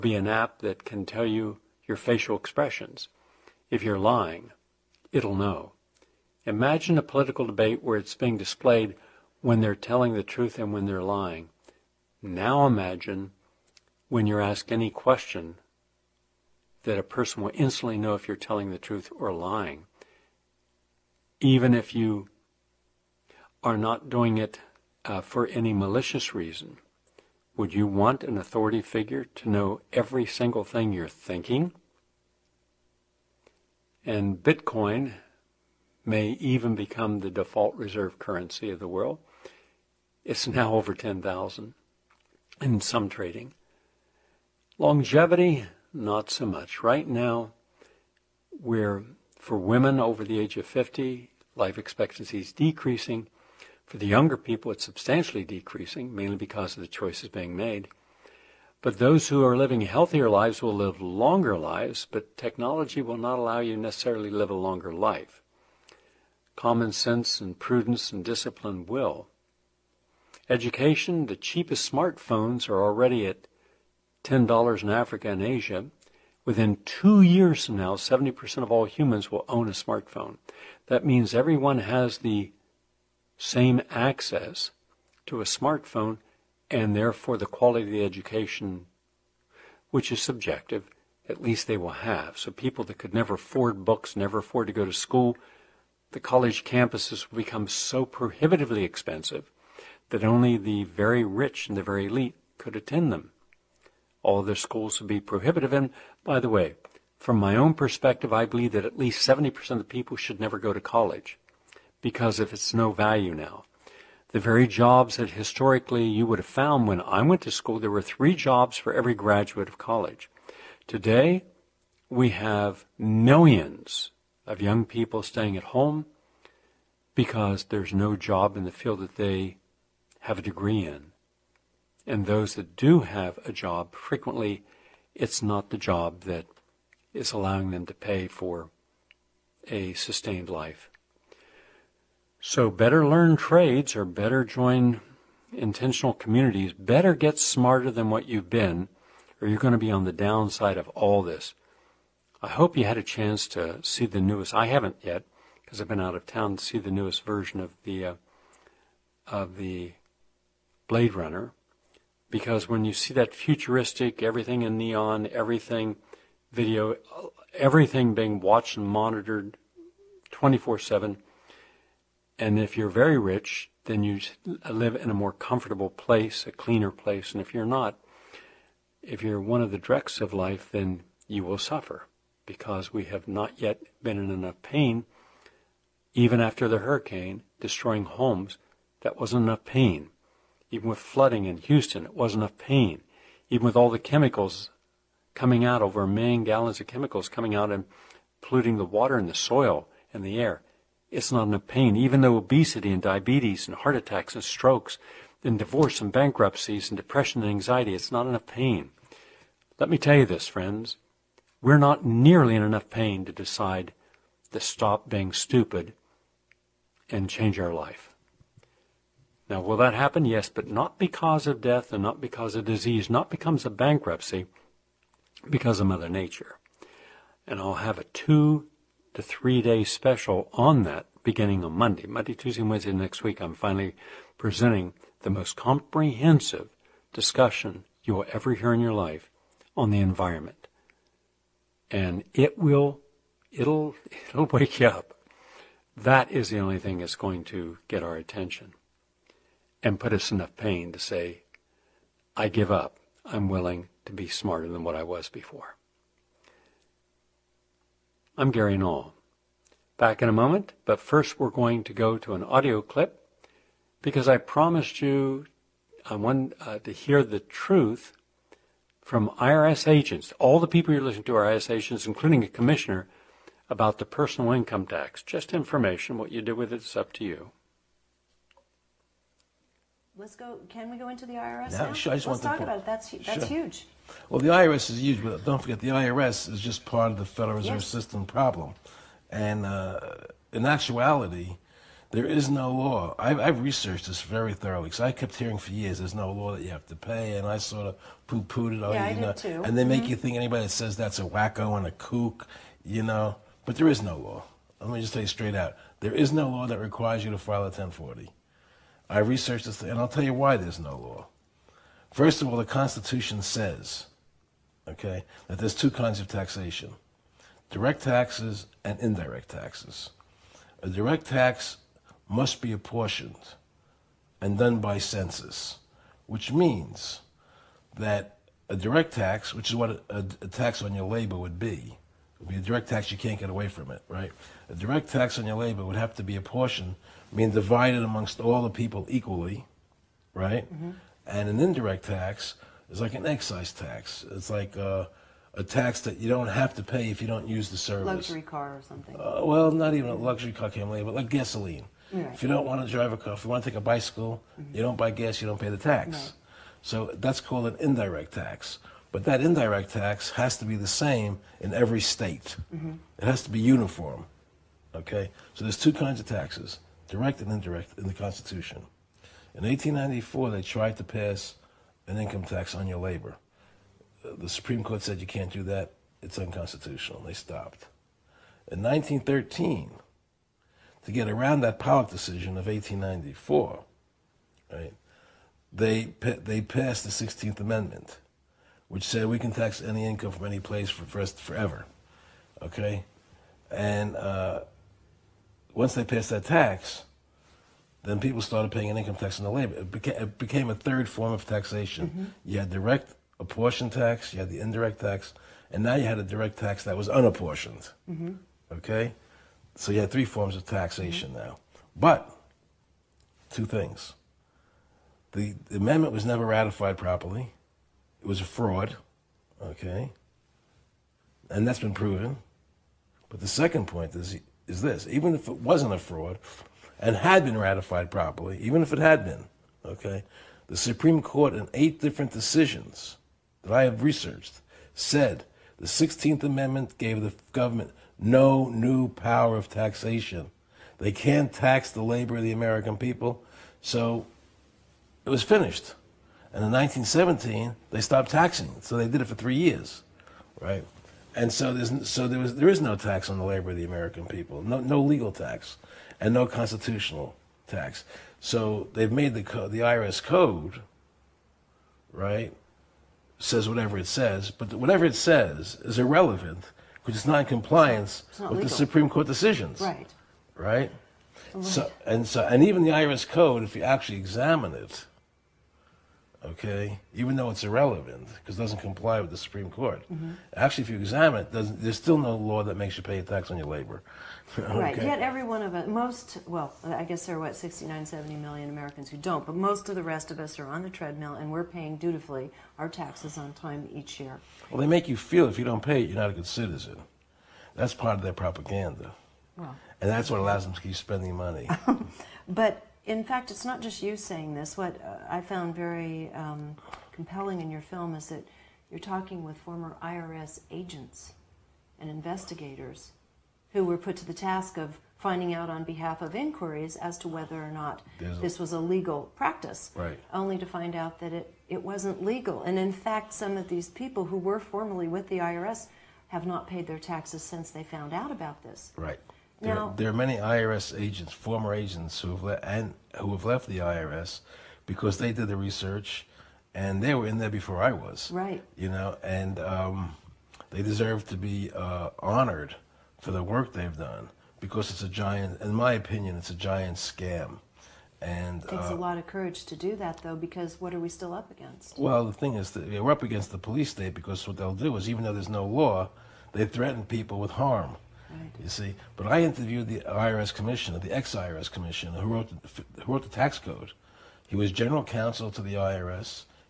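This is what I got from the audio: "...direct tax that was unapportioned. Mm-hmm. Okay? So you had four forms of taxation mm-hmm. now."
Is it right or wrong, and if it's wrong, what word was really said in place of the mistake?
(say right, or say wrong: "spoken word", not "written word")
wrong: "three", not "four".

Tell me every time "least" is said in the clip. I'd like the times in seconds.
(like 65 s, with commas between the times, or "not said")
91 s, 108 s.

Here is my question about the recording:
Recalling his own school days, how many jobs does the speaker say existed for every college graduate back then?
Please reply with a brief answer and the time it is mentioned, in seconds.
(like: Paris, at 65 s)
3 jobs, at 118 s.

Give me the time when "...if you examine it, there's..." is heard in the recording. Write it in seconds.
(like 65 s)
480 s.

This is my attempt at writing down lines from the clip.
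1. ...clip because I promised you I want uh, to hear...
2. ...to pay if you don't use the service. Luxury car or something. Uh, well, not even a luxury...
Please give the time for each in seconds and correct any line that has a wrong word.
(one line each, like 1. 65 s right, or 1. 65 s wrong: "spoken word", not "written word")
1. 262 s right
2. 346 s right.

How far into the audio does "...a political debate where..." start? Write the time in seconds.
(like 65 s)
6 s.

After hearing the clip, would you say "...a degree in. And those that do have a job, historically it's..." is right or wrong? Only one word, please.
wrong.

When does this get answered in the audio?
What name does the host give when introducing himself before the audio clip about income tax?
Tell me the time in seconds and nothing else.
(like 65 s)
258 s.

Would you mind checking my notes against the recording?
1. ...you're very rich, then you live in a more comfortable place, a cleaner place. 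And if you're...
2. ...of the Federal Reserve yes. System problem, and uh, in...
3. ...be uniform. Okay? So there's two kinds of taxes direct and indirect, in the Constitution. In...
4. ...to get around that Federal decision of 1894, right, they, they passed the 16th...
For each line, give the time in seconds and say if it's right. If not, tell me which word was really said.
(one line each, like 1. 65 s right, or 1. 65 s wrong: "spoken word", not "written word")
1. 172 s right
2. 287 s right
3. 363 s right
4. 381 s wrong: "Pollock", not "Federal".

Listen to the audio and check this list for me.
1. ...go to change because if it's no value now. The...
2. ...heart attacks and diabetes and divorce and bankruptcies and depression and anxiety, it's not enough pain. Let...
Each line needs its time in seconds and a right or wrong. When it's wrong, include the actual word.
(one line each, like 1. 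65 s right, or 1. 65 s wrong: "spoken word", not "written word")
1. 110 s wrong: "college", not "change"
2. 203 s wrong: "strokes", not "diabetes".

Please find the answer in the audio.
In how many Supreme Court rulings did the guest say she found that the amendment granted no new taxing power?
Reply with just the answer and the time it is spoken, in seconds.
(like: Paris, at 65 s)
8, at 431 s.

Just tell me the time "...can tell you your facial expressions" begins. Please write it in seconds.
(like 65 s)
0 s.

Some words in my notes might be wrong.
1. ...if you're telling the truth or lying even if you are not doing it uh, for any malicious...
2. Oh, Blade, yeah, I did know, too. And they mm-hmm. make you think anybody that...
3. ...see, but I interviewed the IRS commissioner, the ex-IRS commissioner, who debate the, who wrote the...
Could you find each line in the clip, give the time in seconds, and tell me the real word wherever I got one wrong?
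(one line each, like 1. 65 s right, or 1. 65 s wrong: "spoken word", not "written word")
1. 18 s right
2. 298 s wrong: "All", not "Blade"
3. 558 s wrong: "wrote", not "debate".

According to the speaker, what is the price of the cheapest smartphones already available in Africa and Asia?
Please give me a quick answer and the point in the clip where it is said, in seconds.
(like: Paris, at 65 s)
$10, at 74 s.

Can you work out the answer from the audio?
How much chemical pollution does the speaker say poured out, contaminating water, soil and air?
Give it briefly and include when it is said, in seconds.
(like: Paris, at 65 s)
Over a million gallons, at 195 s.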